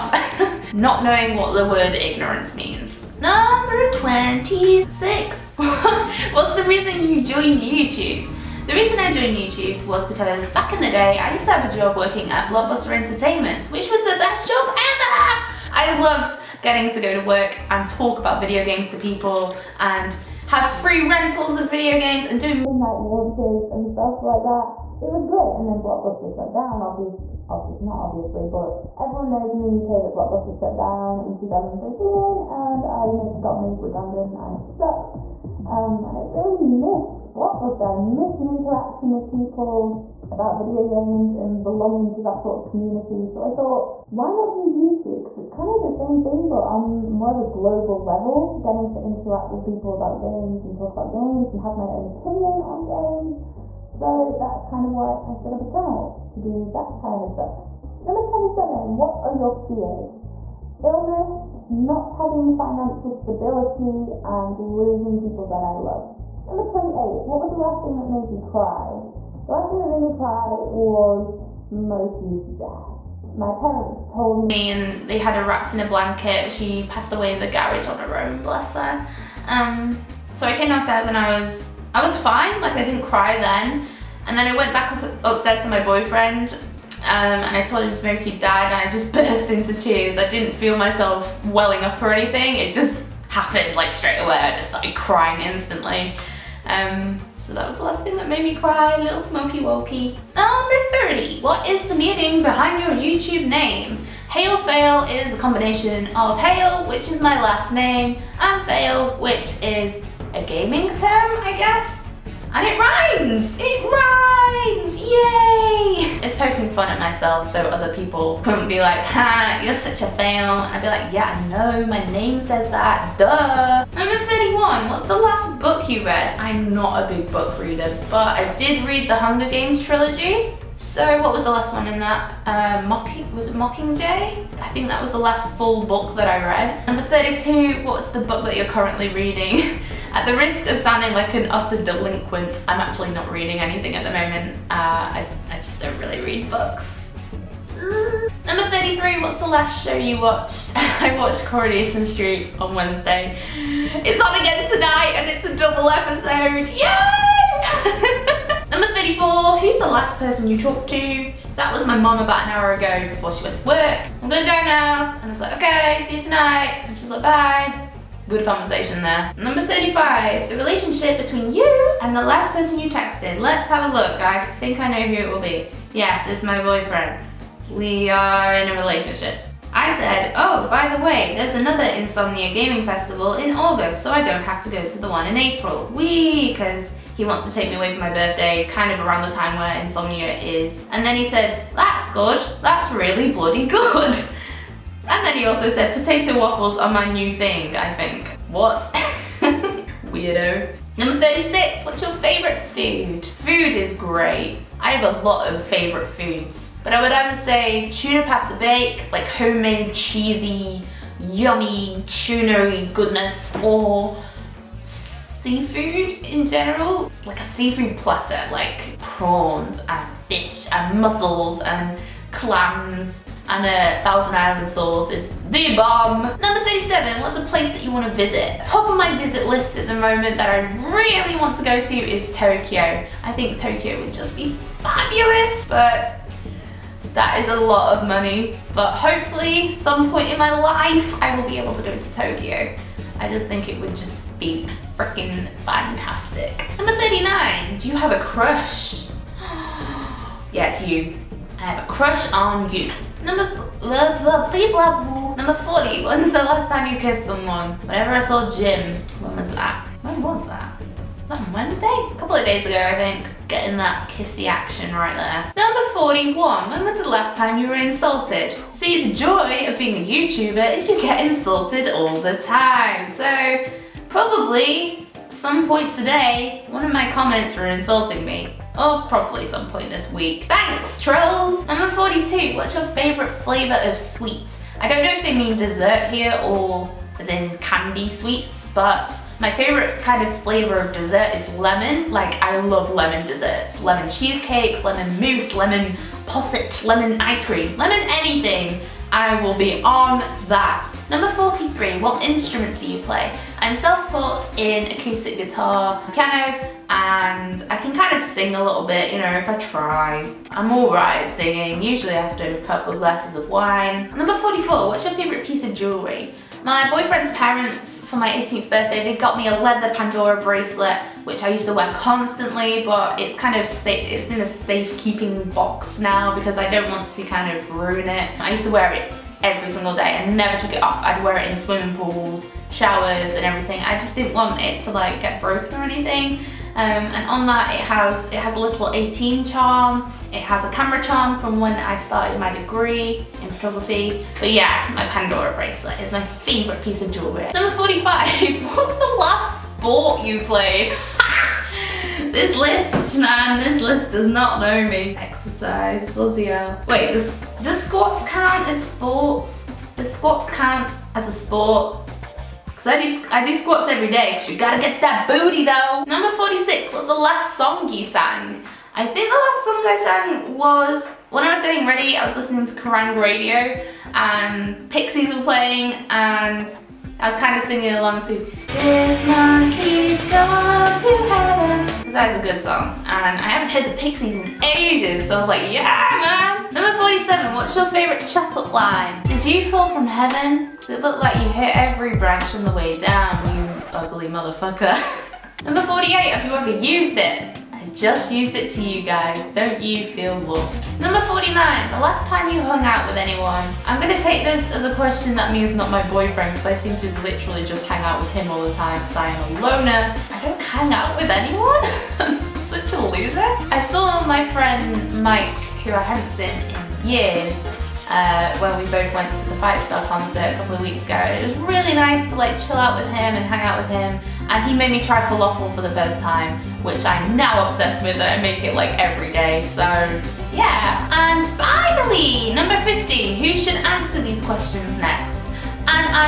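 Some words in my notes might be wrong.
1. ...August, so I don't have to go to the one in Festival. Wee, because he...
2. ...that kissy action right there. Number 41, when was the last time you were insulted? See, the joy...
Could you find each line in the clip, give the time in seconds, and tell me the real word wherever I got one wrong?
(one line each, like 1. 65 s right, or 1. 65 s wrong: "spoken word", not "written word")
1. 183 s wrong: "April", not "Festival"
2. 263 s right.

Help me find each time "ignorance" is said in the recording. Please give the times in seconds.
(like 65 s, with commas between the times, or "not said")
1 s.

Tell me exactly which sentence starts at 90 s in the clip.
I didn't feel myself welling up or anything.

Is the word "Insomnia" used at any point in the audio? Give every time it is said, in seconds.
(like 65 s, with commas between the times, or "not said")
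181 s, 189 s.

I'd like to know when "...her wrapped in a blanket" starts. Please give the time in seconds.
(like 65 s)
75 s.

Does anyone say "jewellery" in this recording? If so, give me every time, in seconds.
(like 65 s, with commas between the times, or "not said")
315 s, 347 s.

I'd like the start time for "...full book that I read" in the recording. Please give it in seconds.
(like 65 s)
135 s.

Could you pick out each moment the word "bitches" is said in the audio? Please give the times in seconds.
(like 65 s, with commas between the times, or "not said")
not said.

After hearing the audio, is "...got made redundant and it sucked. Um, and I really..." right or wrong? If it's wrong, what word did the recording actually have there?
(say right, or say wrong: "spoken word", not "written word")
right.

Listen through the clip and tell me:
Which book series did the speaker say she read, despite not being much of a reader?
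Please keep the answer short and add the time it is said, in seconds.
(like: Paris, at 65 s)
The Hunger Games, at 129 s.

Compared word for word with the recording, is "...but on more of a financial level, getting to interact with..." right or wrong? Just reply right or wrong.
wrong.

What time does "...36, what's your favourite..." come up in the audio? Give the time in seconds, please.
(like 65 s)
201 s.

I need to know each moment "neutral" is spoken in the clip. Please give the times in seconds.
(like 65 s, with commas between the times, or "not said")
not said.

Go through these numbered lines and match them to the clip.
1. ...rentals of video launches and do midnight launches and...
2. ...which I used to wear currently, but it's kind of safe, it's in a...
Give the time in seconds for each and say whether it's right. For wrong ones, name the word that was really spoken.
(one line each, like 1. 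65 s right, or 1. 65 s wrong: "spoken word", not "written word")
1. 21 s wrong: "games", not "launches"
2. 321 s wrong: "constantly", not "currently".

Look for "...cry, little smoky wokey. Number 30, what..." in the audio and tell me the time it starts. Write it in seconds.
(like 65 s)
98 s.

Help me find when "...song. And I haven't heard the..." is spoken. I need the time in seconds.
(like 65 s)
382 s.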